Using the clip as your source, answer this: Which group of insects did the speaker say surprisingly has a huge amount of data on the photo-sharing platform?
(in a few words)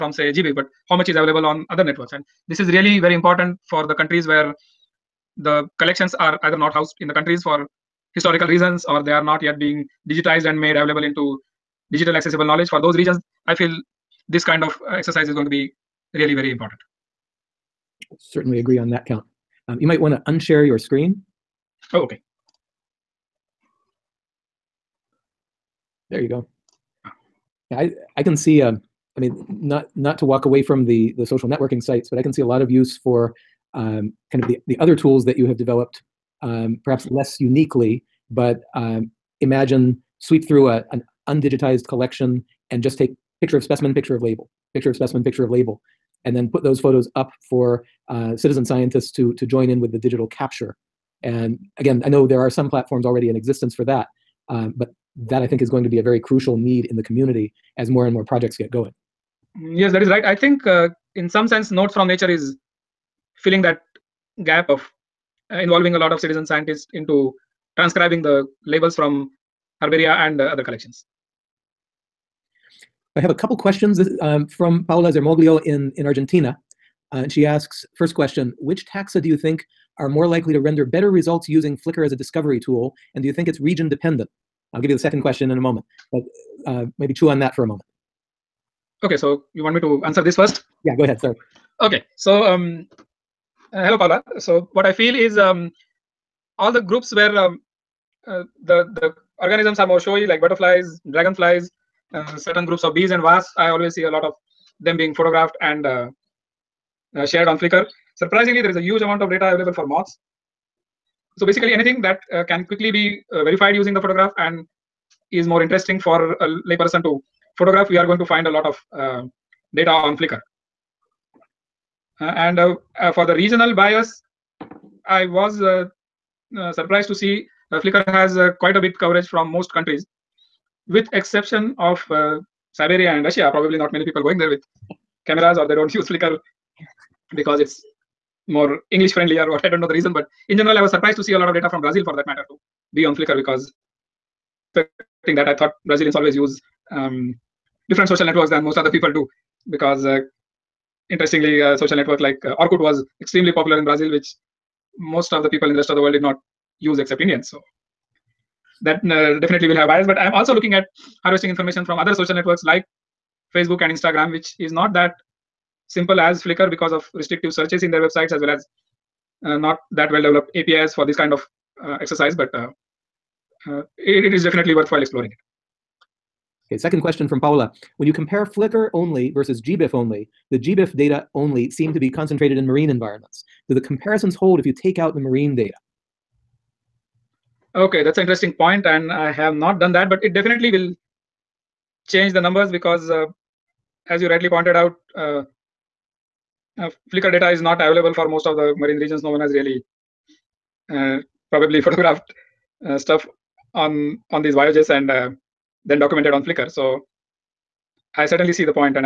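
Moths.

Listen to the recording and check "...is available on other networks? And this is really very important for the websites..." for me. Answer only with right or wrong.
wrong.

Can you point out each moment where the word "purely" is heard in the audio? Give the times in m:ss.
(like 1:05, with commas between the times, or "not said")
not said.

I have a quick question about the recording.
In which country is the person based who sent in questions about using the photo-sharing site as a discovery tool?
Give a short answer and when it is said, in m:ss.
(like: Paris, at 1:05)
Argentina, at 1:16.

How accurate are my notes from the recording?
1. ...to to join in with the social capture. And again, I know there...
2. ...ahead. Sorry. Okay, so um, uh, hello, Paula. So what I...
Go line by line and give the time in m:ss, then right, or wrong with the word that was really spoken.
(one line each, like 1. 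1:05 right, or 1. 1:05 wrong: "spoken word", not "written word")
1. 0:49 wrong: "digital", not "social"
2. 1:31 right.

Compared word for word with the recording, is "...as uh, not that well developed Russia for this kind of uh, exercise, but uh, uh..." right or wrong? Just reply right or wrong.
wrong.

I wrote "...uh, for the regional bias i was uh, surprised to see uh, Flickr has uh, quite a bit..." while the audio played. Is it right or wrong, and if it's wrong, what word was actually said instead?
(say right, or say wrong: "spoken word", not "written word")
right.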